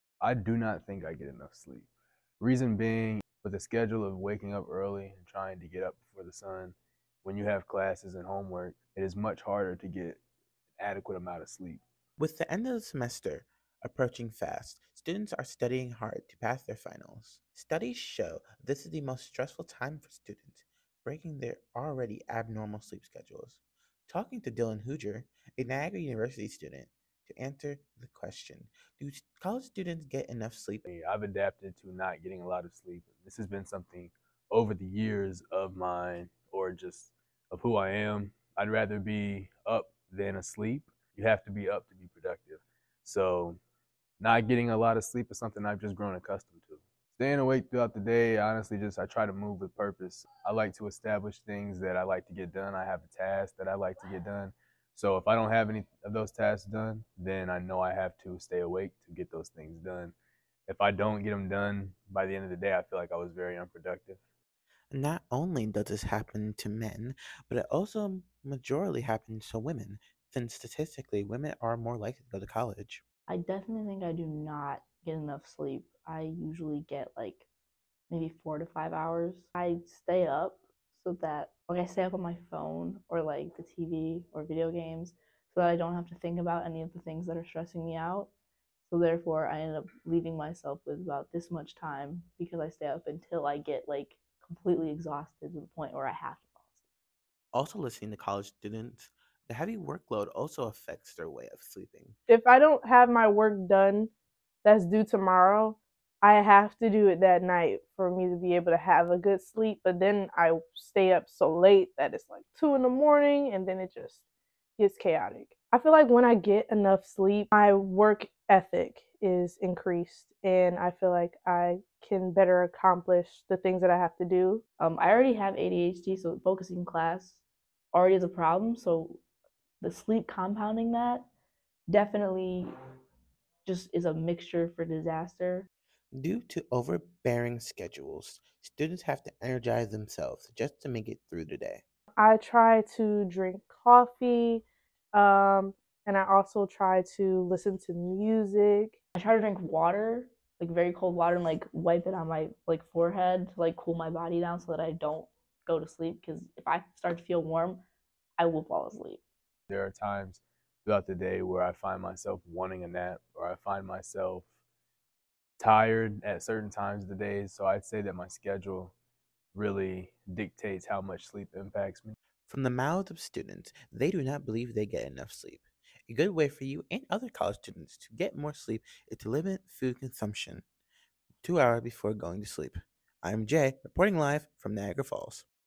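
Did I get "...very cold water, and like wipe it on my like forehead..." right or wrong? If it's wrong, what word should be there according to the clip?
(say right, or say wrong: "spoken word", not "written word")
right.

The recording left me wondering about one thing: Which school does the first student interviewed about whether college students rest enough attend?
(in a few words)
Niagara University.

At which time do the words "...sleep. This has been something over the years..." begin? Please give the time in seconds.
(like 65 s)
32 s.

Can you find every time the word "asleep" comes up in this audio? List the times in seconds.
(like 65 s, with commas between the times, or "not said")
40 s, 96 s, 158 s.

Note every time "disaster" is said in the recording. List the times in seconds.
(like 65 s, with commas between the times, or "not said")
134 s.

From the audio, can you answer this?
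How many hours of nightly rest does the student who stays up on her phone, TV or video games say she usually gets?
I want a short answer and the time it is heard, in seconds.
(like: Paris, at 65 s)
4 to 5 hours, at 78 s.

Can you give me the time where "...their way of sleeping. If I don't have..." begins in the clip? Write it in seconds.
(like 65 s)
101 s.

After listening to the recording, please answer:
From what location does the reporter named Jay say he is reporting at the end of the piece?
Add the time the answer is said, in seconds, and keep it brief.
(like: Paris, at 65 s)
Niagara Falls, at 184 s.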